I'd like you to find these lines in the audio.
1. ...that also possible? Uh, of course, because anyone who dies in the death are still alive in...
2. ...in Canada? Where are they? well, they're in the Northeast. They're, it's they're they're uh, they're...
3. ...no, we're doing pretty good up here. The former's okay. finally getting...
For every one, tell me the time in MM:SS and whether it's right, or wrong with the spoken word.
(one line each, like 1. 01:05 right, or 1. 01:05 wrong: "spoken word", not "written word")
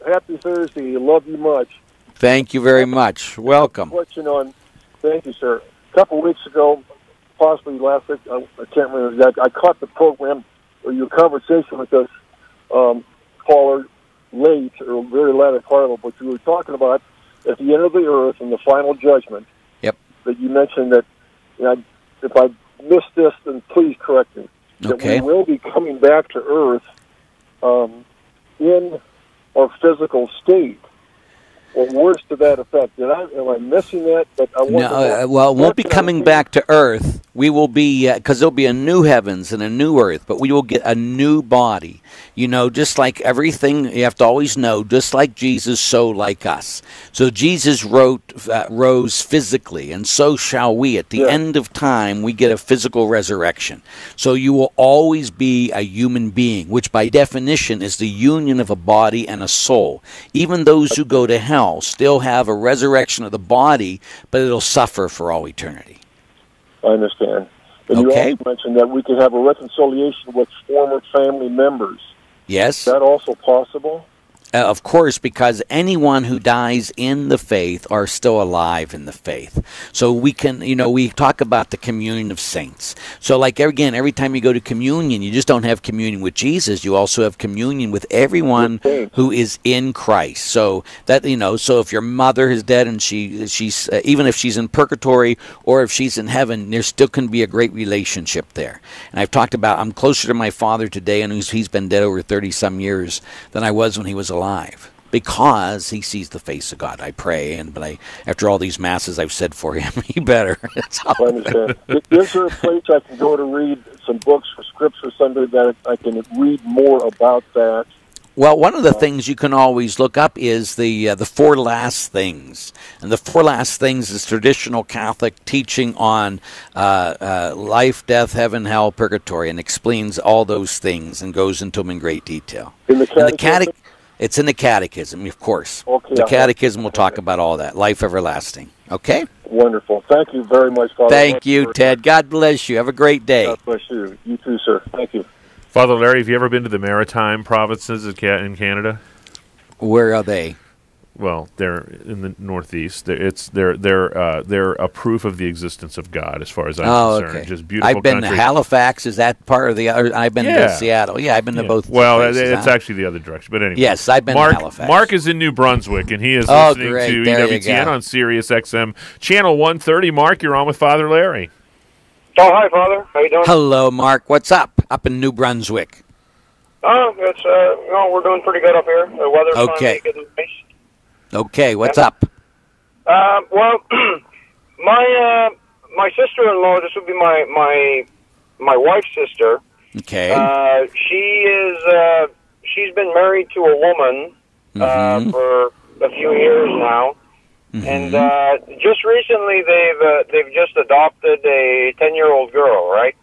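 1. 01:12 wrong: "faith", not "death"
2. 02:28 right
3. 02:57 wrong: "weather", not "former".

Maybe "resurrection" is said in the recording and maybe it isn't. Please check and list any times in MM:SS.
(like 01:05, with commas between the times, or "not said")
00:53, 01:02.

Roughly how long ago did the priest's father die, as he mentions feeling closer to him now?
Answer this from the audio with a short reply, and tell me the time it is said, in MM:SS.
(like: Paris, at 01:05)
Over 30, at 01:42.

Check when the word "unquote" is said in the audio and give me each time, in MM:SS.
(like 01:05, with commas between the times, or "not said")
not said.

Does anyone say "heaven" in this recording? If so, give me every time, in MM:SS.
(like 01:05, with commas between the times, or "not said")
00:39, 01:36, 02:08.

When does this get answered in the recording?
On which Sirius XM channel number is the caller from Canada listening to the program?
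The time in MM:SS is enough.
02:49.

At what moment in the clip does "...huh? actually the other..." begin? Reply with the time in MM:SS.
02:42.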